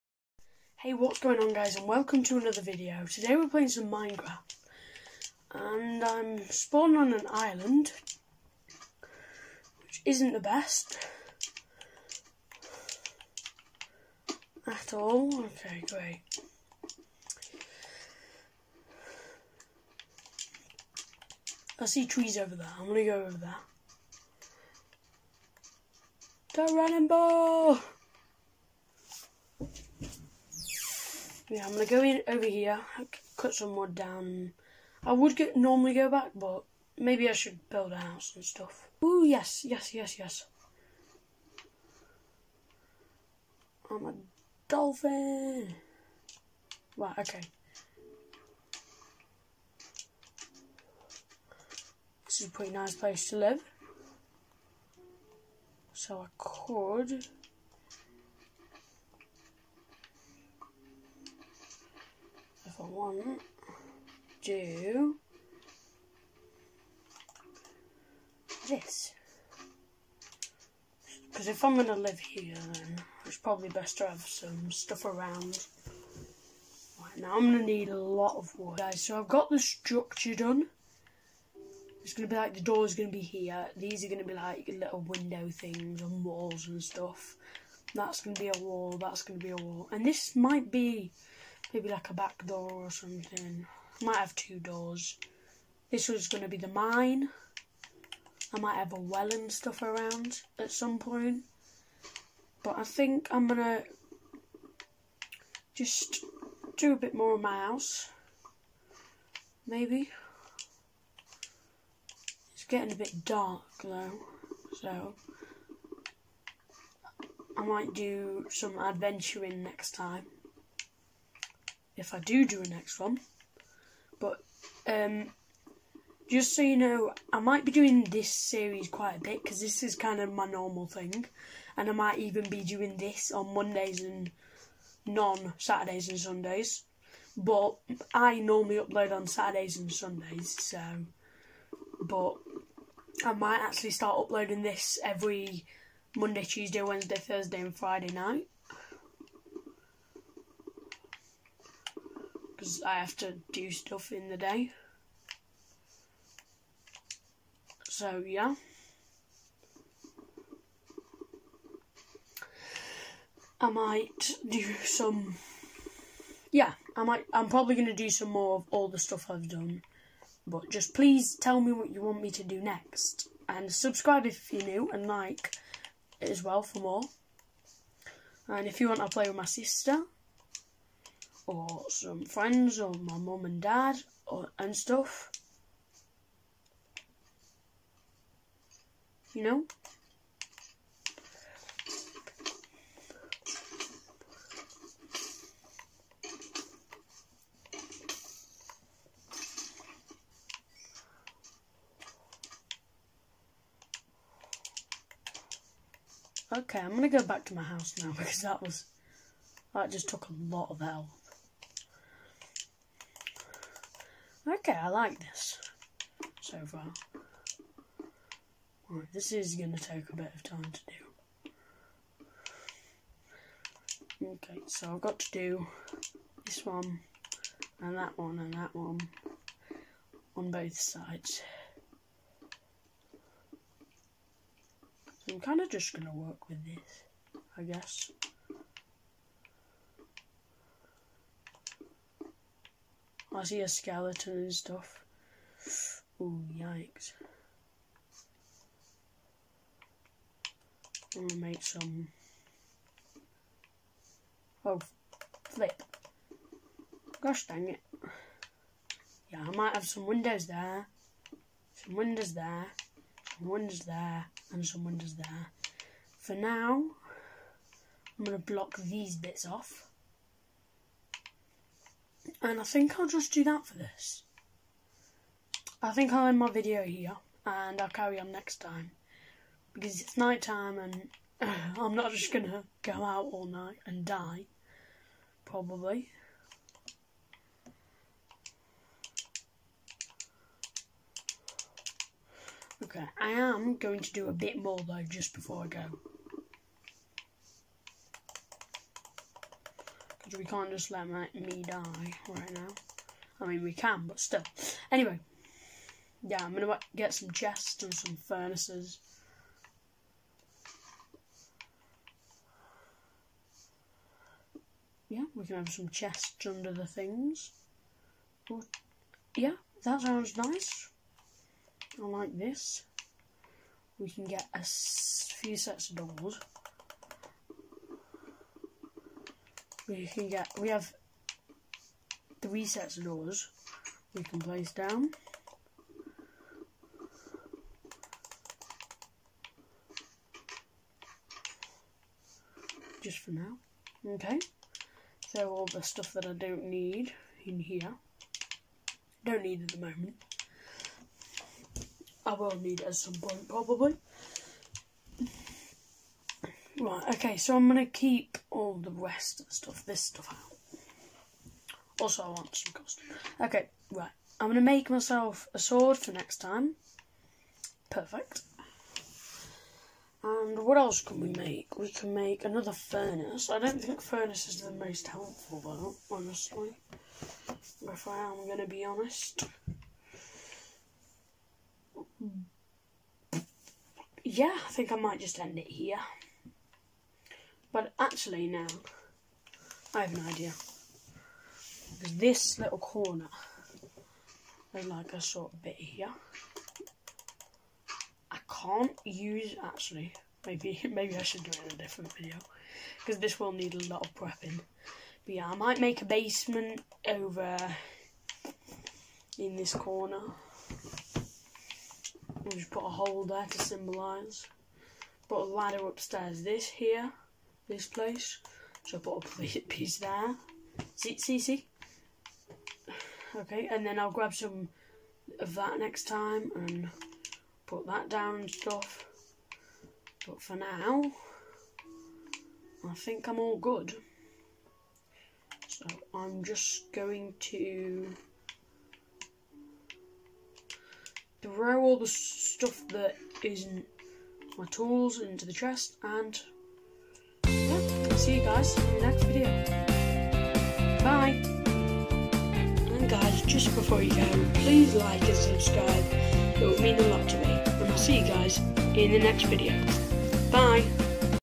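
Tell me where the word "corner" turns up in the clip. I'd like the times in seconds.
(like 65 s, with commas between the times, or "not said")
392 s, 409 s.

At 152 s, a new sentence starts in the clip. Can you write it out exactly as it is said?
because I have to do stuff in the day.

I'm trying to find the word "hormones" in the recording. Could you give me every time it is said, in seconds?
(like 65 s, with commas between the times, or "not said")
not said.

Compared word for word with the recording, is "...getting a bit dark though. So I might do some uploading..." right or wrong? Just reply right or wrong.
wrong.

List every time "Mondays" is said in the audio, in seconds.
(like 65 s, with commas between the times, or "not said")
133 s, 146 s.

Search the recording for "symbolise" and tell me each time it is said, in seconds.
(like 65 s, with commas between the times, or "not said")
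413 s.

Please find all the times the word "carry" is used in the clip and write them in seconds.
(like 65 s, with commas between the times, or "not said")
277 s.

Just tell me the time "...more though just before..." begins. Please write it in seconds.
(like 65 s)
294 s.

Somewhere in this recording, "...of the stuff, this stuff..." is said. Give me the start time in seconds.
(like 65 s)
359 s.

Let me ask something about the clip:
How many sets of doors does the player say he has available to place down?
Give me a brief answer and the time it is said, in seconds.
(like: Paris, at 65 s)
3, at 332 s.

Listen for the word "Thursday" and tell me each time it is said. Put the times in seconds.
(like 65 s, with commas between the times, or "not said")
147 s.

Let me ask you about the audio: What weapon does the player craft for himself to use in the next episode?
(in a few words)
A sword.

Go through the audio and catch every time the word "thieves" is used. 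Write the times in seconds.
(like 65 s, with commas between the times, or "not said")
not said.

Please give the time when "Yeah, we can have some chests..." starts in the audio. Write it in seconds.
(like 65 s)
315 s.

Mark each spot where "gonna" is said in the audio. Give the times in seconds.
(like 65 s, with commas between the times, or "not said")
22 s, 31 s, 206 s, 251 s, 268 s, 306 s.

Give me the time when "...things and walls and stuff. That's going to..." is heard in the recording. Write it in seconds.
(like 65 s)
85 s.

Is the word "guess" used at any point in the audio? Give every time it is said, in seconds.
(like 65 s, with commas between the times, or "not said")
237 s.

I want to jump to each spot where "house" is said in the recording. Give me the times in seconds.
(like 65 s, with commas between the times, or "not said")
37 s, 107 s, 207 s.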